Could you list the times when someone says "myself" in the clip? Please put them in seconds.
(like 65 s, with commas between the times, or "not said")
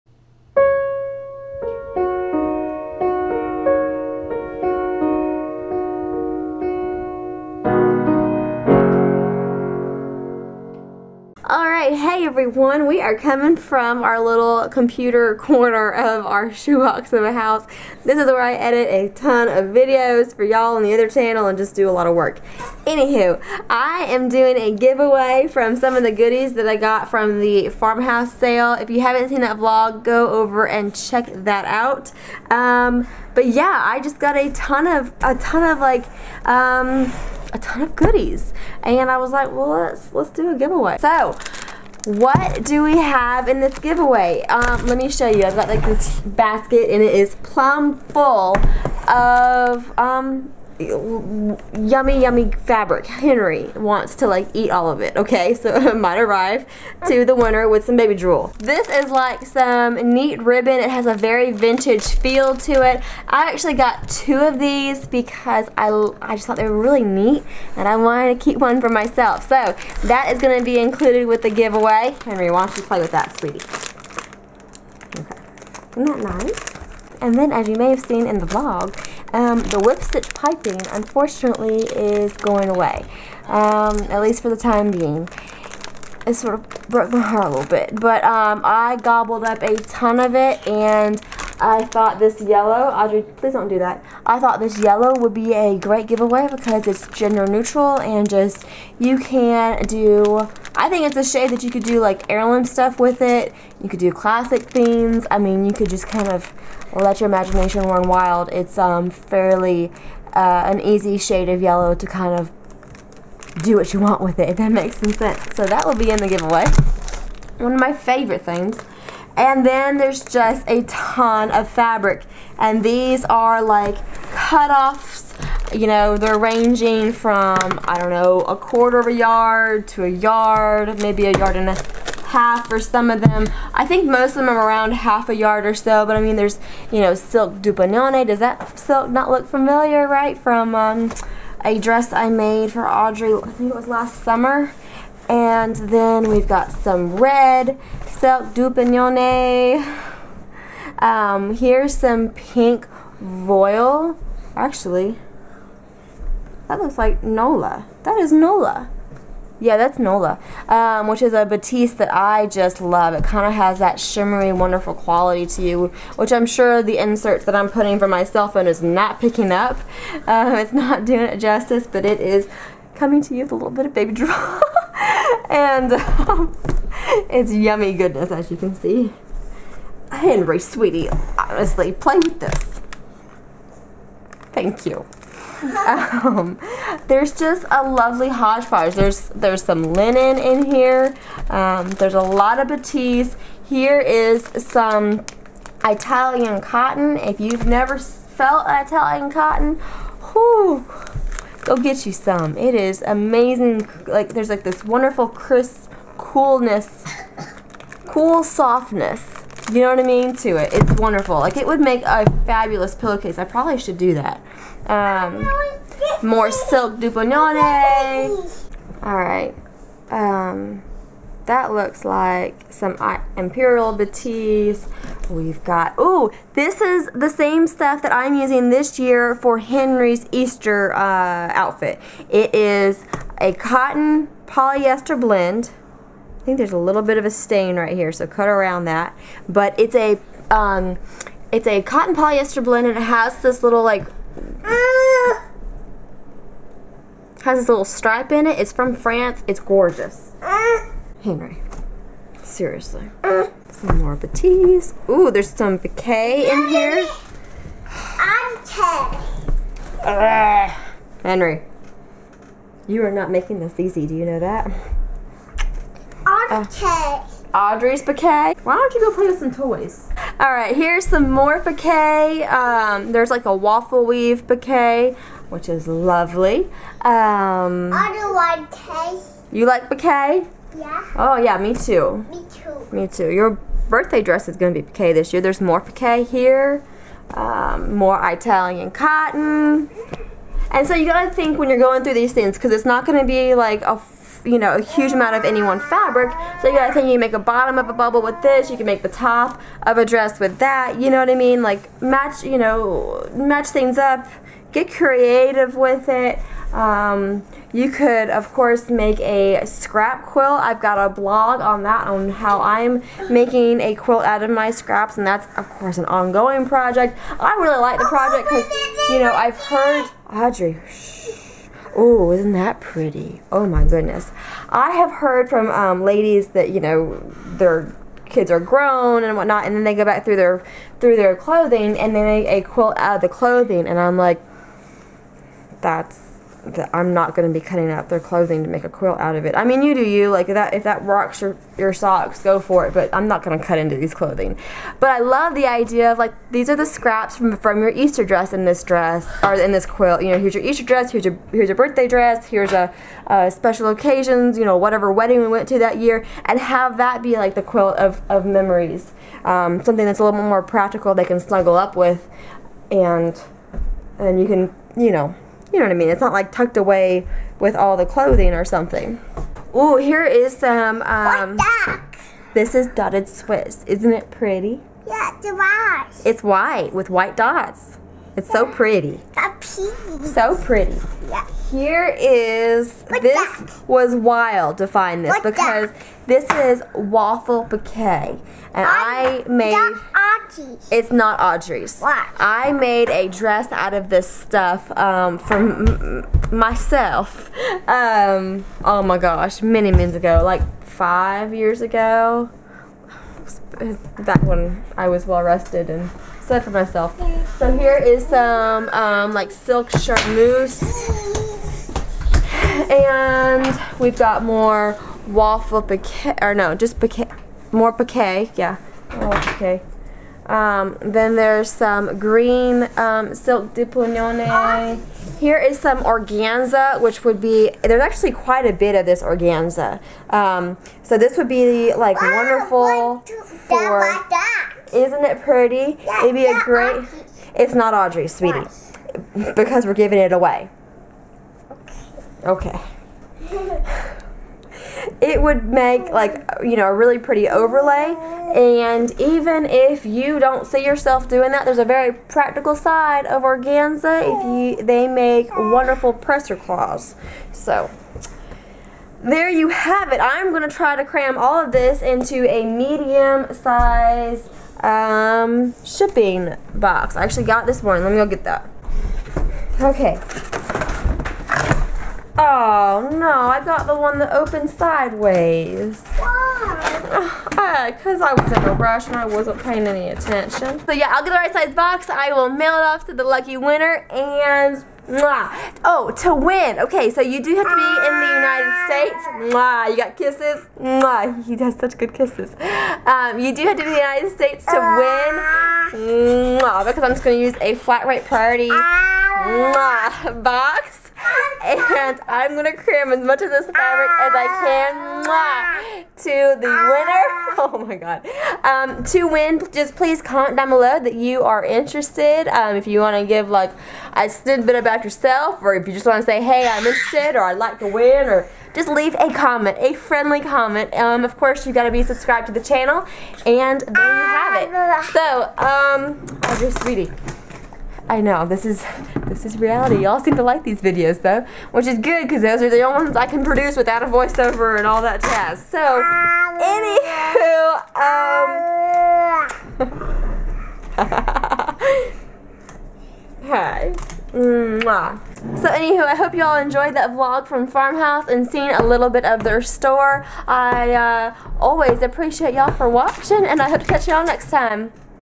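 68 s, 396 s, 406 s.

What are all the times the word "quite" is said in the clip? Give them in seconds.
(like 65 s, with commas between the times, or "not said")
428 s.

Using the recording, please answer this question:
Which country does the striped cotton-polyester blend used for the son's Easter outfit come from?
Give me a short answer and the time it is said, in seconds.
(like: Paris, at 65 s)
France, at 248 s.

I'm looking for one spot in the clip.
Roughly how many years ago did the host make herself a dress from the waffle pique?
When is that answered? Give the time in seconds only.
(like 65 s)
400 s.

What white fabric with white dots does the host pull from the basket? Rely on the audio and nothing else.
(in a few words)
Dotted Swiss.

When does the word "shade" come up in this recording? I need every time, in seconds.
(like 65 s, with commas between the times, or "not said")
101 s, 111 s.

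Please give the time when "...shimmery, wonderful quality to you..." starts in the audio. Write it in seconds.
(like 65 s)
163 s.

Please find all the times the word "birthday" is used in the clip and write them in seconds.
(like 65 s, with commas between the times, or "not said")
283 s, 351 s.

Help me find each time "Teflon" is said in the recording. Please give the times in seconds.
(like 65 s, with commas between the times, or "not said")
not said.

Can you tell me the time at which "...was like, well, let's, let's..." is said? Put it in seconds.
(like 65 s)
39 s.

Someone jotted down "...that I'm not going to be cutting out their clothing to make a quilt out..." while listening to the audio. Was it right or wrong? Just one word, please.
right.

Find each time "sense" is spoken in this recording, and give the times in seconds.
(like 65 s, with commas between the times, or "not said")
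115 s.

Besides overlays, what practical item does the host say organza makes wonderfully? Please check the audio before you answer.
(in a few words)
Press cloths.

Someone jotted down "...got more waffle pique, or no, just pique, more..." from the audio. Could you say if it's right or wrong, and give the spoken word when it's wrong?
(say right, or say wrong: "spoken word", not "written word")
right.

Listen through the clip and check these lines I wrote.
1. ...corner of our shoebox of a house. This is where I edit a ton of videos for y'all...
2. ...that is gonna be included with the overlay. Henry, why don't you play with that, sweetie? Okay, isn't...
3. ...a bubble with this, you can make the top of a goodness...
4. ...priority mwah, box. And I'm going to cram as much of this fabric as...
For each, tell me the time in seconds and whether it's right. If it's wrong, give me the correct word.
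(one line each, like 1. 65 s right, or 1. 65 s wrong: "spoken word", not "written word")
1. 15 s right
2. 70 s wrong: "giveaway", not "overlay"
3. 297 s wrong: "dress", not "goodness"
4. 498 s right.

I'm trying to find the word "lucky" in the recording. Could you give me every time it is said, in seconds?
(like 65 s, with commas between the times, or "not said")
483 s.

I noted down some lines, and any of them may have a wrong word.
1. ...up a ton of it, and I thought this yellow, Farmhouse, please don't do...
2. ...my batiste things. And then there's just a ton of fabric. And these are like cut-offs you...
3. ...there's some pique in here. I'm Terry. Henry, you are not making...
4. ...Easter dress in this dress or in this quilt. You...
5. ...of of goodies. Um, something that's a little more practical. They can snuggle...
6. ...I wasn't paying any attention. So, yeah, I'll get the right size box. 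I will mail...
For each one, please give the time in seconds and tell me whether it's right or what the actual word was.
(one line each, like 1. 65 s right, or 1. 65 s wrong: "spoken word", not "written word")
1. 89 s wrong: "Audrey", not "Farmhouse"
2. 117 s wrong: "favorite", not "batiste"
3. 255 s right
4. 347 s right
5. 357 s wrong: "memories", not "goodies"
6. 479 s right.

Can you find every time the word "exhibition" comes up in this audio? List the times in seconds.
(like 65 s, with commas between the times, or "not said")
not said.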